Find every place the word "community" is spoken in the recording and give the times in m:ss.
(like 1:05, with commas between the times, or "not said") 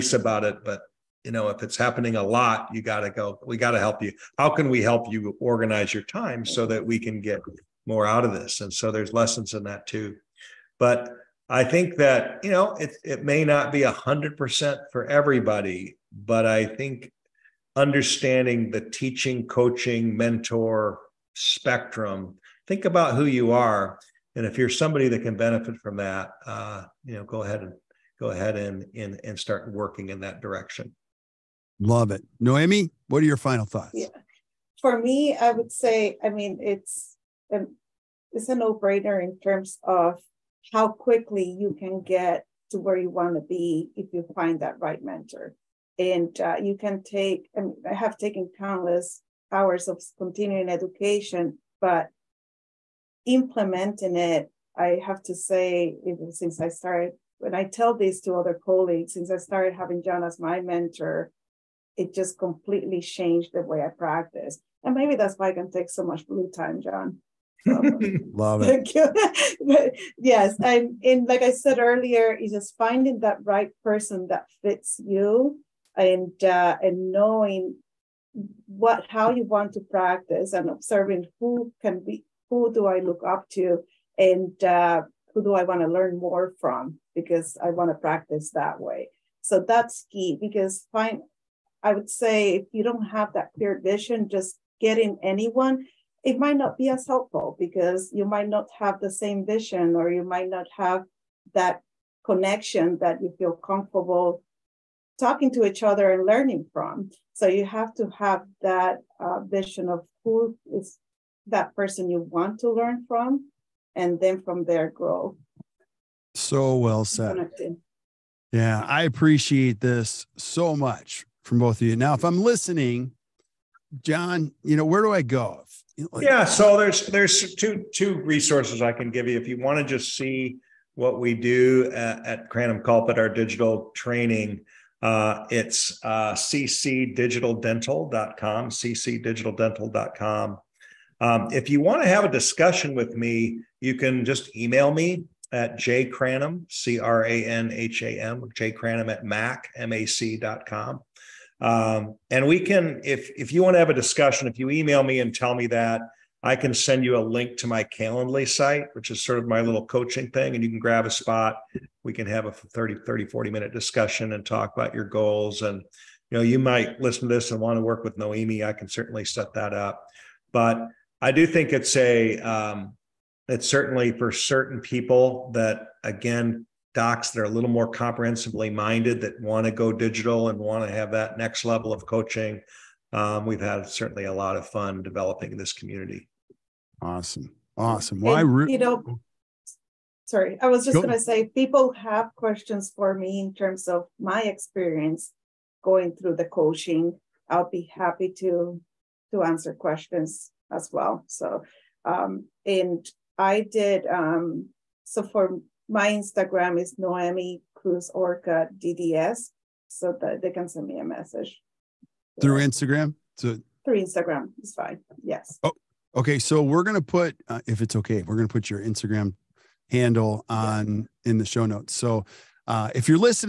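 3:05.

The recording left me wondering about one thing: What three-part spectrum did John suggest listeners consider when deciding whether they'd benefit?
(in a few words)
teaching coaching mentor.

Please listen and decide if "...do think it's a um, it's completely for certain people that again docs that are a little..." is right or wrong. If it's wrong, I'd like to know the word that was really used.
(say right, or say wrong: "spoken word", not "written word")
wrong: "certainly", not "completely".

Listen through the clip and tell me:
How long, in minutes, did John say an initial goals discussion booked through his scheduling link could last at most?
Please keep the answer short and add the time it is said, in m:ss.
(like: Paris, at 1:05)
40, at 2:43.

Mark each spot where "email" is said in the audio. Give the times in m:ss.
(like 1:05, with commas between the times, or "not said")
2:24, 2:34.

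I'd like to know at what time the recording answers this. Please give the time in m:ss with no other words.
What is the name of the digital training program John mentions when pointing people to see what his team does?
2:12.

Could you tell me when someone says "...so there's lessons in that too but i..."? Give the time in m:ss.
0:08.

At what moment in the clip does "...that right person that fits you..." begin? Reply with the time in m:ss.
1:13.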